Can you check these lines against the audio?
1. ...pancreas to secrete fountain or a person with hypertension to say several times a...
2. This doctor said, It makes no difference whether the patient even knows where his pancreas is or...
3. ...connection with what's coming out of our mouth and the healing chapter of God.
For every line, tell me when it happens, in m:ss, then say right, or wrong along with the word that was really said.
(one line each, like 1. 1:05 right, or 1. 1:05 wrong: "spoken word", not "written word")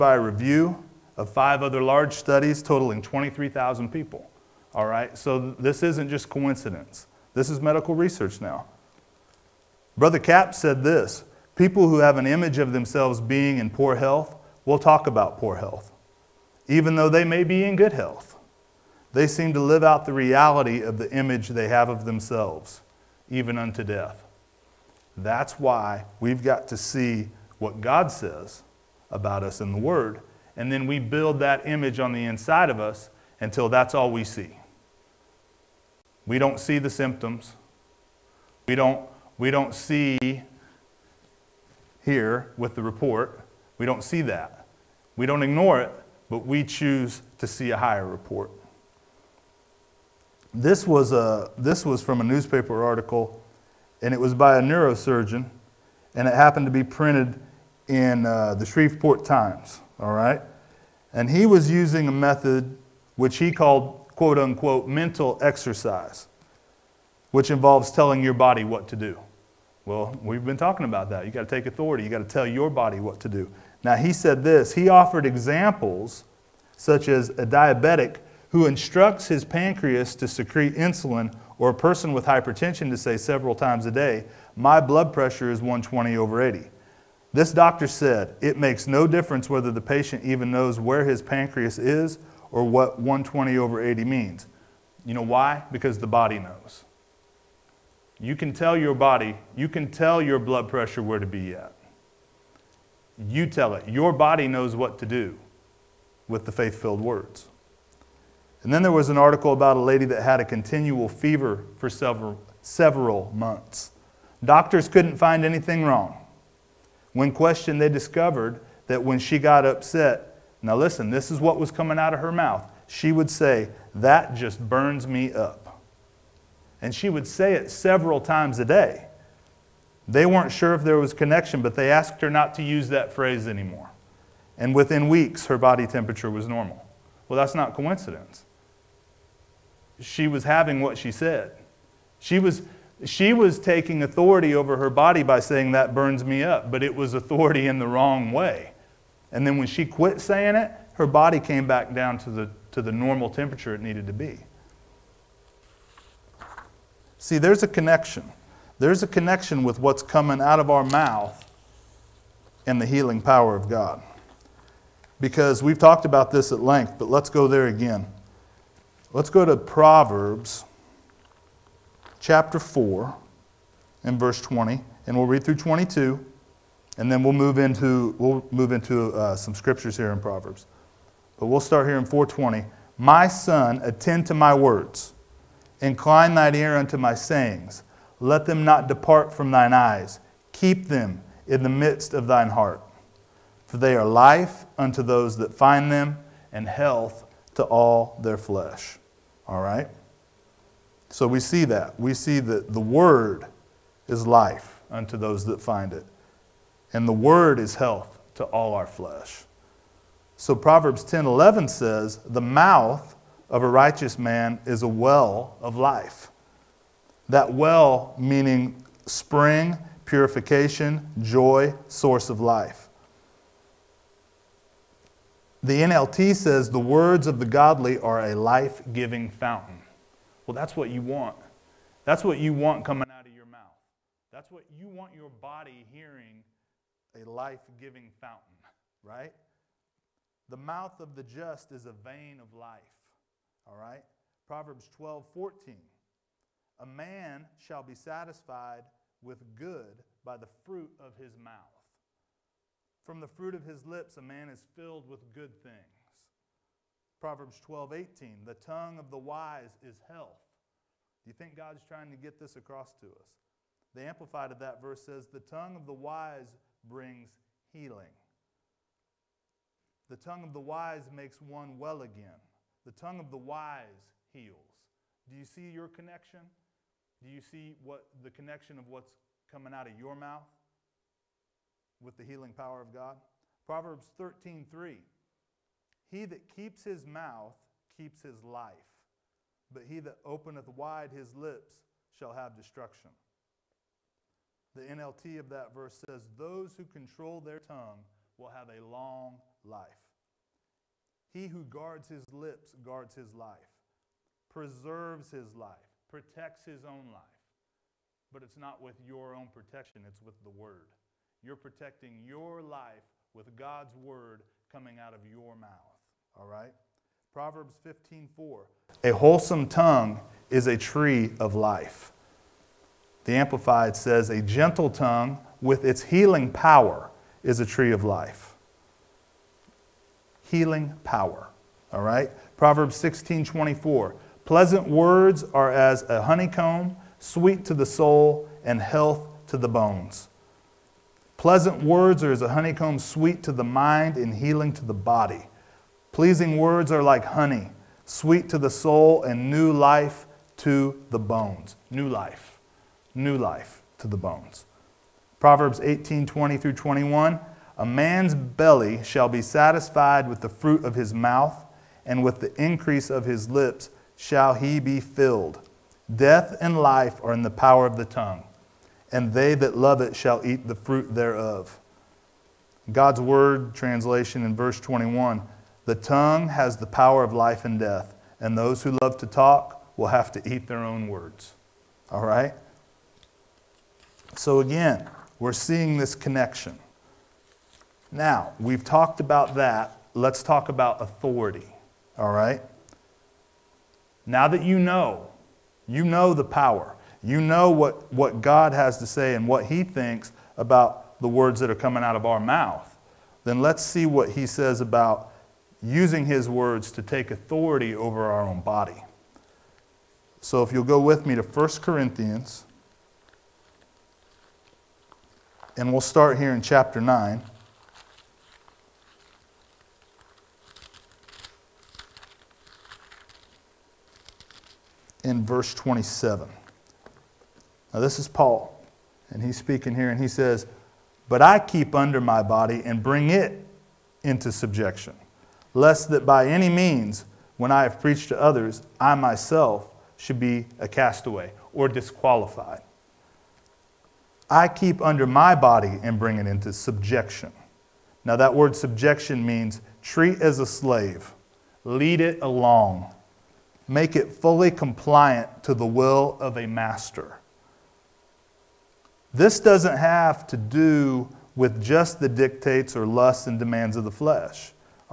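1. 1:19 wrong: "insulin", not "fountain"
2. 1:27 right
3. 2:39 wrong: "power", not "chapter".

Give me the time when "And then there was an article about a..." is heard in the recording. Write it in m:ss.
1:48.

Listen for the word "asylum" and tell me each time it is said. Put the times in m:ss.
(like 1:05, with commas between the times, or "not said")
not said.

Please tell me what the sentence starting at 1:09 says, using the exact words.
Well, we've been talking about that.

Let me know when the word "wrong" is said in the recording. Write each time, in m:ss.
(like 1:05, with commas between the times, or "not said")
1:55, 2:27.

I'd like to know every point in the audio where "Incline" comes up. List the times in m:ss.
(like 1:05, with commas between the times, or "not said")
3:05.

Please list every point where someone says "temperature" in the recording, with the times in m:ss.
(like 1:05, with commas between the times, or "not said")
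2:15, 2:33.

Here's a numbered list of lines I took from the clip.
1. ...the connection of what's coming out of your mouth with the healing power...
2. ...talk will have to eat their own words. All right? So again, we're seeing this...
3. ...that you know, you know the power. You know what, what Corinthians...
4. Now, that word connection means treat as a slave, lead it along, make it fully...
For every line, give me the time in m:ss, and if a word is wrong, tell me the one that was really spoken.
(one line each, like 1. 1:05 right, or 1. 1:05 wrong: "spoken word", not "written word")
1. 4:38 right
2. 6:19 right
3. 6:34 wrong: "God", not "Corinthians"
4. 7:28 wrong: "subjection", not "connection".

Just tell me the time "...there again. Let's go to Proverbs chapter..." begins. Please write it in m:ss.
2:47.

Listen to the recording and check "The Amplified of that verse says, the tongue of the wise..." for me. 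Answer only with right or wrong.
right.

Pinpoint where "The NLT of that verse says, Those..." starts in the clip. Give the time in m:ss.
4:54.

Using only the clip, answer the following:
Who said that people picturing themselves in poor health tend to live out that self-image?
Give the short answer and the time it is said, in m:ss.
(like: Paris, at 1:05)
Brother Capps, at 0:09.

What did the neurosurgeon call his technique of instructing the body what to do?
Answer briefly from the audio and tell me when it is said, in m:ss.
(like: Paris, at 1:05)
mental exercise, at 1:04.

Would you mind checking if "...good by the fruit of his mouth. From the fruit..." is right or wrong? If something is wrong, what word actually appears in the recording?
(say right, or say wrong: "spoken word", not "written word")
right.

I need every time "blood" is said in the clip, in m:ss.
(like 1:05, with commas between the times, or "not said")
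1:24, 1:40.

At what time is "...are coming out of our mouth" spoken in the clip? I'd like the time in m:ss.
6:41.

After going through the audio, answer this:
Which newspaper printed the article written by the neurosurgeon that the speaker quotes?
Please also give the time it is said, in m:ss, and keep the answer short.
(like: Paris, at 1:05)
Shreveport Times, at 0:58.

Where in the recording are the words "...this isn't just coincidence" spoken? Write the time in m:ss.
0:05.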